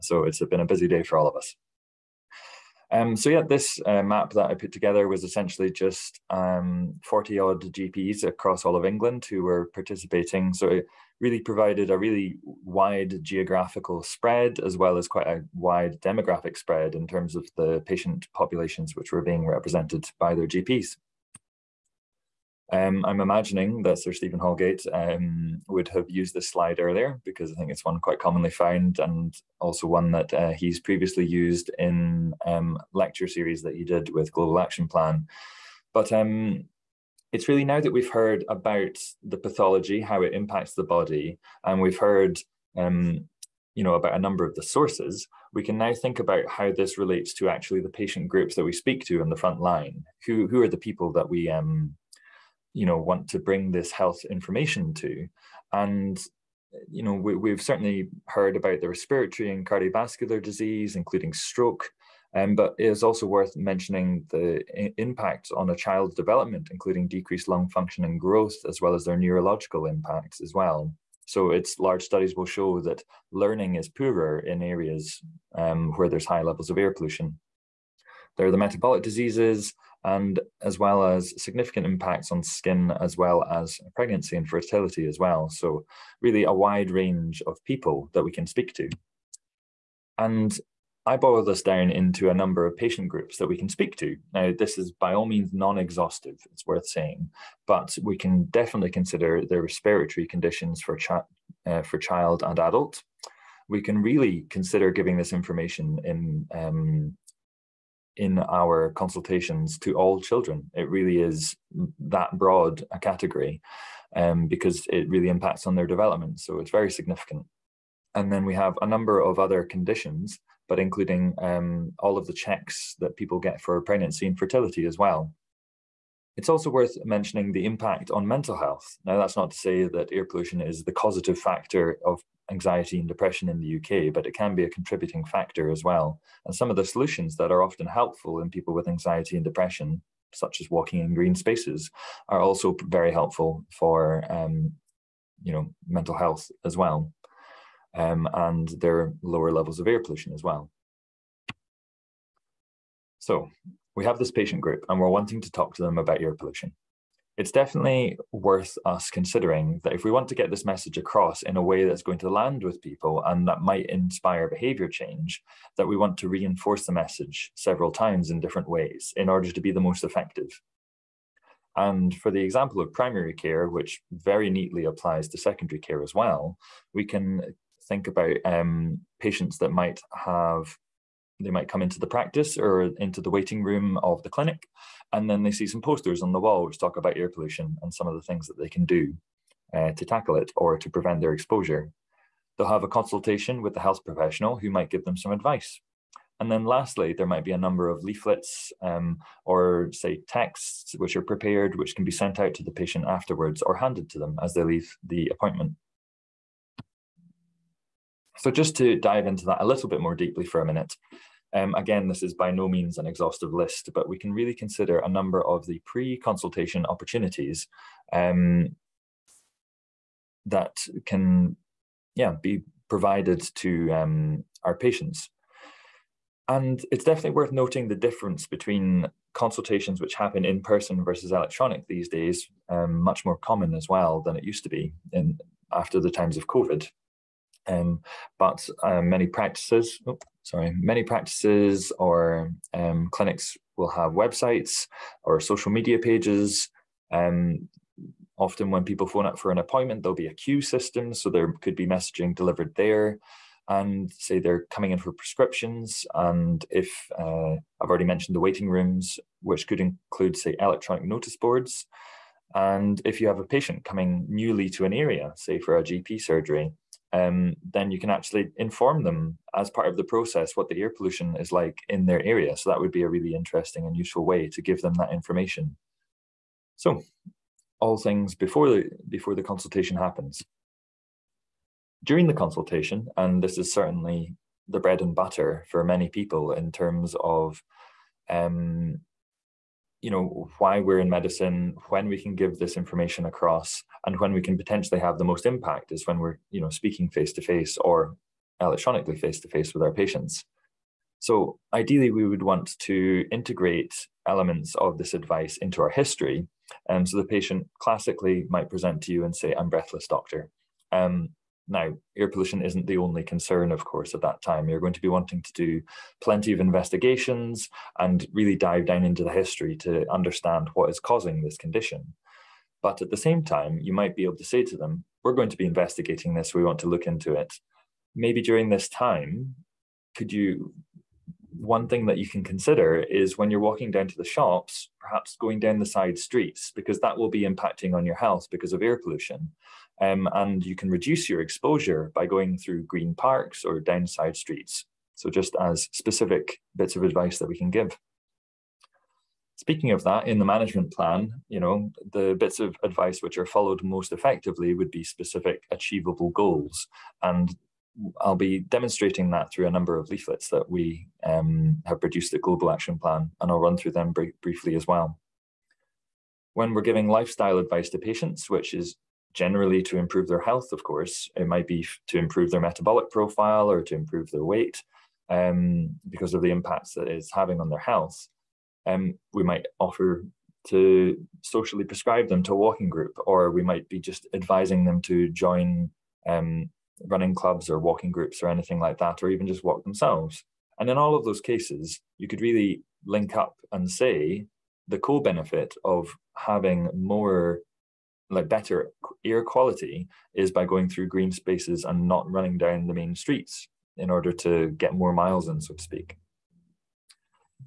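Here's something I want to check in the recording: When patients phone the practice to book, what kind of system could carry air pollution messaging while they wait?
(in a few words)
queue system.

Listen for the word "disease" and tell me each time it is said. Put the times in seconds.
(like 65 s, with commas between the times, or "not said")
60 s, 79 s.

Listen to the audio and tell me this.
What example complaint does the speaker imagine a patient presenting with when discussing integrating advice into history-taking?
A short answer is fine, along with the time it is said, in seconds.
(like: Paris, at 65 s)
breathless, at 309 s.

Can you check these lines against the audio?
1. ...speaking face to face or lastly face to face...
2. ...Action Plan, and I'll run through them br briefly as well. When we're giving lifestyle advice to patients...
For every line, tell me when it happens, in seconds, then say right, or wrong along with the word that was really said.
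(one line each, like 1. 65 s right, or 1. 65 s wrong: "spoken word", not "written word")
1. 296 s wrong: "electronically", not "lastly"
2. 362 s right.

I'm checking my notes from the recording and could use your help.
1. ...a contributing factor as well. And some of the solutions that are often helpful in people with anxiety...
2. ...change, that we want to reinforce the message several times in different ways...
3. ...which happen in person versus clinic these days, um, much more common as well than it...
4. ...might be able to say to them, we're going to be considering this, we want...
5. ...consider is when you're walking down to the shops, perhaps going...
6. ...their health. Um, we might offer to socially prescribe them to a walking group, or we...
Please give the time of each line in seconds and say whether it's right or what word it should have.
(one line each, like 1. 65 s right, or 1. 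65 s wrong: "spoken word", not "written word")
1. 134 s right
2. 164 s right
3. 230 s wrong: "electronic", not "clinic"
4. 323 s wrong: "investigating", not "considering"
5. 332 s right
6. 377 s right.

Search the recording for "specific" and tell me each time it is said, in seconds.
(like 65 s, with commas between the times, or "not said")
345 s, 355 s.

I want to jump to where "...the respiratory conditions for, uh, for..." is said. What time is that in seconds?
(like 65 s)
99 s.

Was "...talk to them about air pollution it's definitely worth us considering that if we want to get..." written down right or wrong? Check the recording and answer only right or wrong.
right.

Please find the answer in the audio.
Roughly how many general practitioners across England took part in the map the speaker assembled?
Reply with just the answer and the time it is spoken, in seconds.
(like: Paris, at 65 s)
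40, at 7 s.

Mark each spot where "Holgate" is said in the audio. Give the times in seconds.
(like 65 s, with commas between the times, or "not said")
24 s.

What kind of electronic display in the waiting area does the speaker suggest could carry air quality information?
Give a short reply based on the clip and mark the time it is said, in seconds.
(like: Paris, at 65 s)
electronic notice boards, at 260 s.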